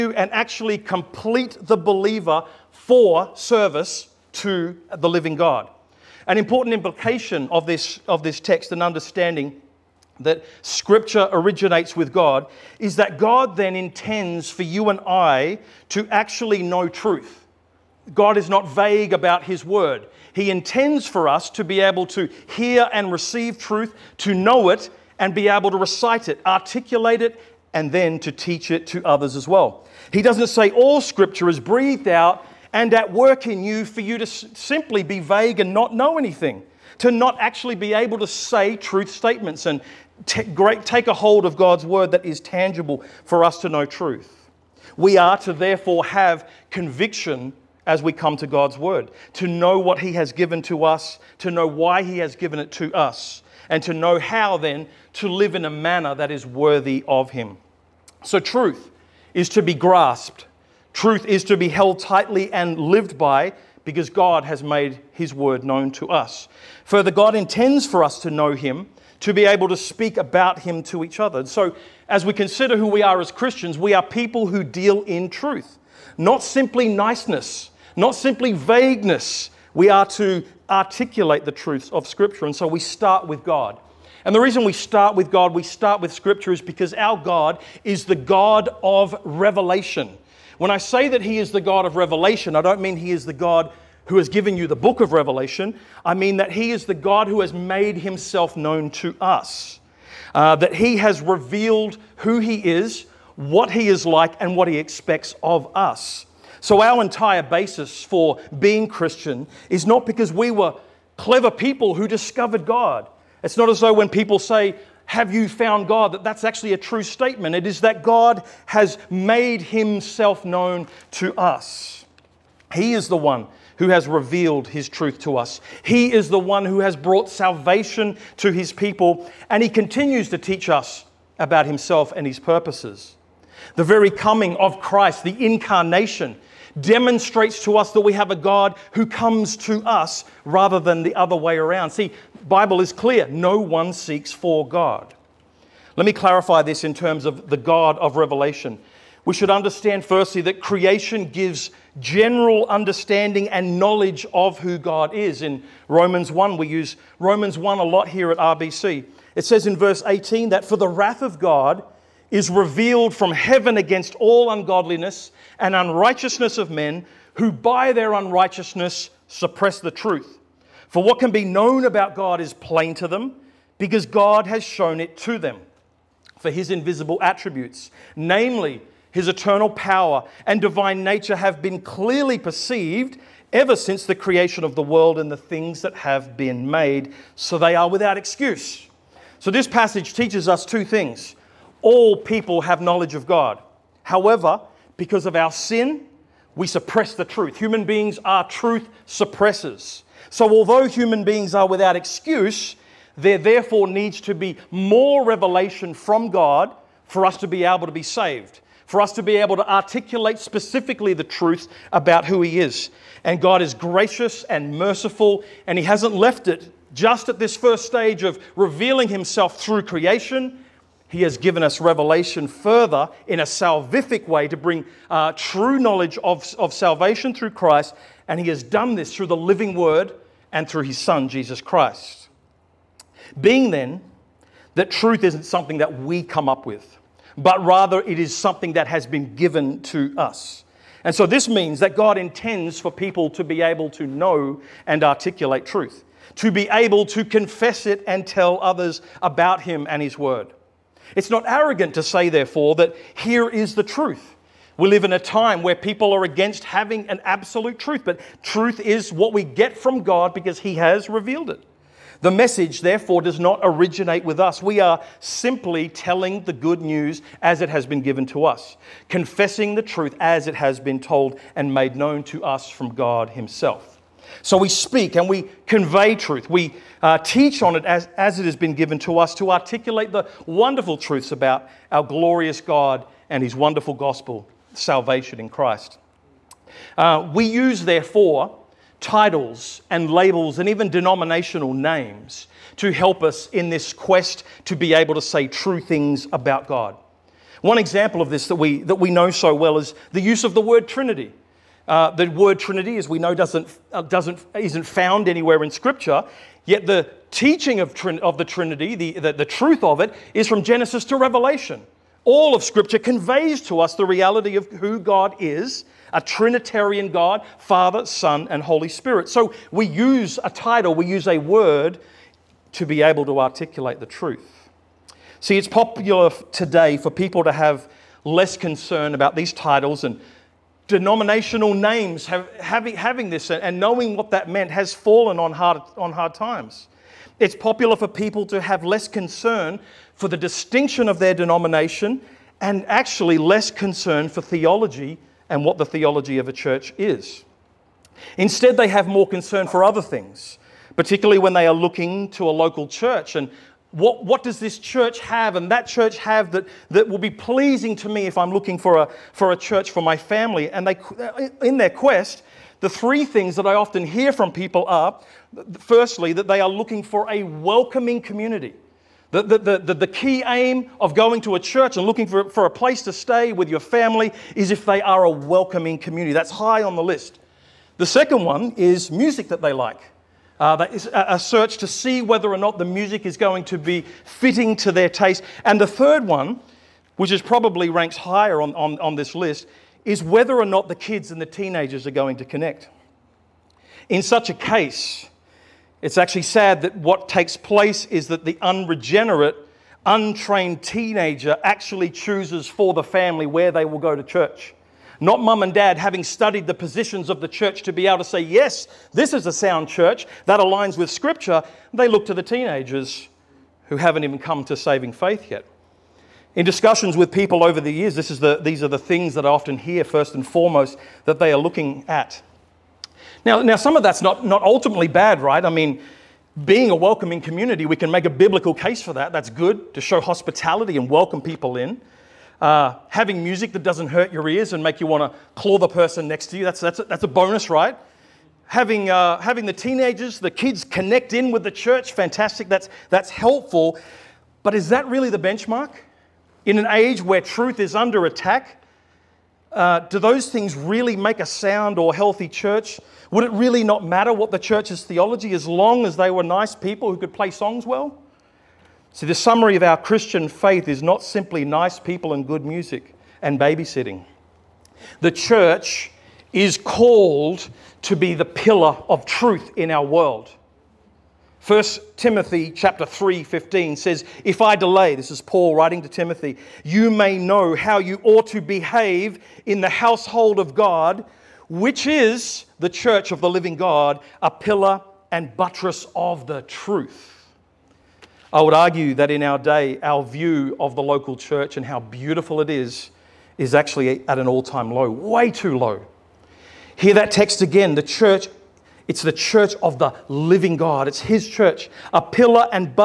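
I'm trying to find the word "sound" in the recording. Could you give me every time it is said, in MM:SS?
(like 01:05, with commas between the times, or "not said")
06:49, 07:31.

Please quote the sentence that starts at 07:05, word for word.
I mean, being a welcoming community, we can make a biblical case for that.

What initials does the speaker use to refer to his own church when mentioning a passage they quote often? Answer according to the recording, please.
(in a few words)
RBC.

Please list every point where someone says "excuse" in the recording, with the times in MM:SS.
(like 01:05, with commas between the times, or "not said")
03:08, 03:21.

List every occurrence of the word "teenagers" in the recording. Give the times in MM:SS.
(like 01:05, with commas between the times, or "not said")
06:31, 06:40, 06:52, 07:19.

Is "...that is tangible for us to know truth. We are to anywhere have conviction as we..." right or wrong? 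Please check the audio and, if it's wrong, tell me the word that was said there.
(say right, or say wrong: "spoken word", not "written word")
wrong: "therefore", not "anywhere".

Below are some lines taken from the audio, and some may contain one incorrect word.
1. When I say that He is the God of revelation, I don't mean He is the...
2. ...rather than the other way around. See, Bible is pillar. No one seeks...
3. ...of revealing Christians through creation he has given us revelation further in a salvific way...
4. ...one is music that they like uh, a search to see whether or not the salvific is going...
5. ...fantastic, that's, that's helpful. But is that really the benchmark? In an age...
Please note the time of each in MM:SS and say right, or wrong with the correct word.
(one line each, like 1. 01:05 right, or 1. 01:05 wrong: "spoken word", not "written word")
1. 01:30 right
2. 02:20 wrong: "clear", not "pillar"
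3. 03:38 wrong: "Himself", not "Christians"
4. 06:18 wrong: "music", not "salvific"
5. 07:22 right.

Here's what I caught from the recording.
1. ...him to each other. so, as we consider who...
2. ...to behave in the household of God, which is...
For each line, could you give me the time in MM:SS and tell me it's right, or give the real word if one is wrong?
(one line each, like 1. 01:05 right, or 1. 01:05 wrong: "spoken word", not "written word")
1. 01:10 right
2. 07:58 right.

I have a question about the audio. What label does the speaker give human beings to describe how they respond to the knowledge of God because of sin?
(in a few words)
truth suppressors.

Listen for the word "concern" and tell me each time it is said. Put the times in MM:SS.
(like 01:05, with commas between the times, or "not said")
05:28, 05:39, 05:43, 05:49.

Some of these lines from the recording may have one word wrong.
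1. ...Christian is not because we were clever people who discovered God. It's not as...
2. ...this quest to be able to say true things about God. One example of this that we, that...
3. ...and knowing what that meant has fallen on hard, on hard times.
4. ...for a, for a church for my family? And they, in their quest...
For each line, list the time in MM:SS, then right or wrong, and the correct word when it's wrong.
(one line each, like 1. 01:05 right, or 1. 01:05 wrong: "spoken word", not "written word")
1. 01:48 right
2. 04:53 right
3. 05:33 right
4. 05:58 right.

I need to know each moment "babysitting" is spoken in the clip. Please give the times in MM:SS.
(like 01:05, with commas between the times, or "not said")
07:43.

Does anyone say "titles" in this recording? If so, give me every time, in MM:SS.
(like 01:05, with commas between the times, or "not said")
04:49, 05:20, 05:29.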